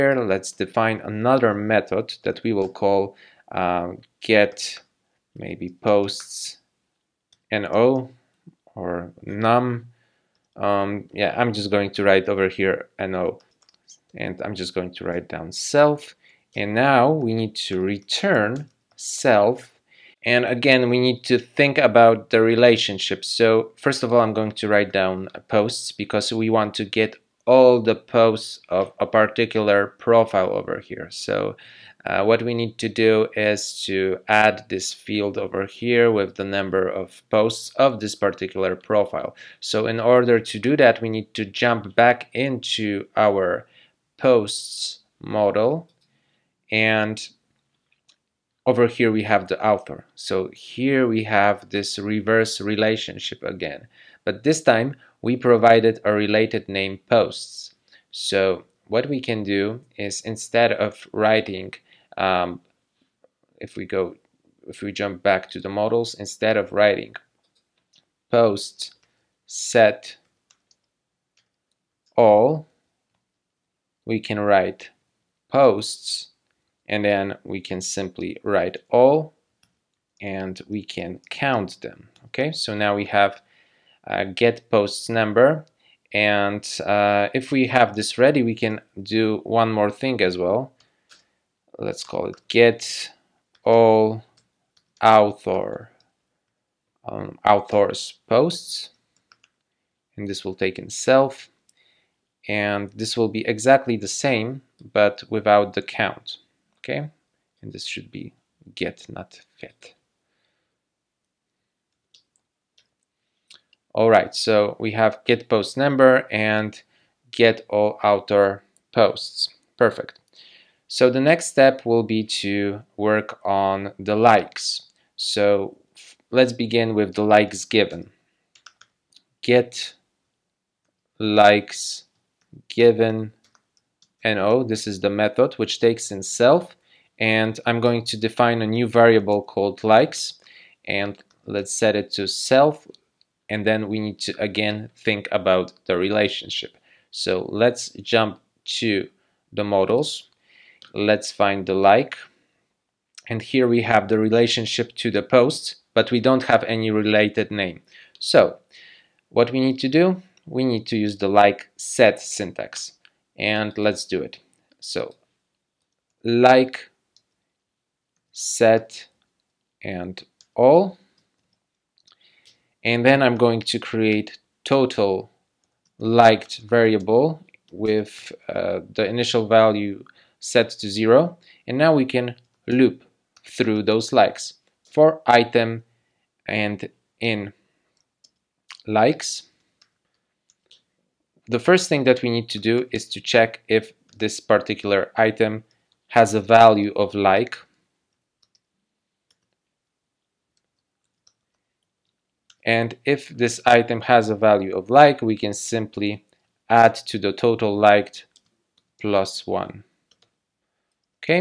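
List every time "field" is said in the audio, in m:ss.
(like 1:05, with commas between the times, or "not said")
0:34.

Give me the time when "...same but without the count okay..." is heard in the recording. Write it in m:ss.
1:44.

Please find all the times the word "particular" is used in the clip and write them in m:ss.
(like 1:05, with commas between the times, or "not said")
0:29, 0:38, 3:14.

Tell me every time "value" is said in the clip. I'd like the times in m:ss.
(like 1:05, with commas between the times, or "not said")
2:59, 3:16, 3:24.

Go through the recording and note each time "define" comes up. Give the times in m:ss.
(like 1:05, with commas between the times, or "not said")
0:00, 2:18.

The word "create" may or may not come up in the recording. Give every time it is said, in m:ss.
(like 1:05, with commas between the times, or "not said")
2:53.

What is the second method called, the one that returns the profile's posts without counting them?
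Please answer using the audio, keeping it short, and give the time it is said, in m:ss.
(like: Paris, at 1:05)
get all author posts, at 1:57.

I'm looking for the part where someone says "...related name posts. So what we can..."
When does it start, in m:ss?
0:56.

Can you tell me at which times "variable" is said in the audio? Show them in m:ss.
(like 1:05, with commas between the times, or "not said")
2:18, 2:56.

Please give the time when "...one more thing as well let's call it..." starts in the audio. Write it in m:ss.
1:29.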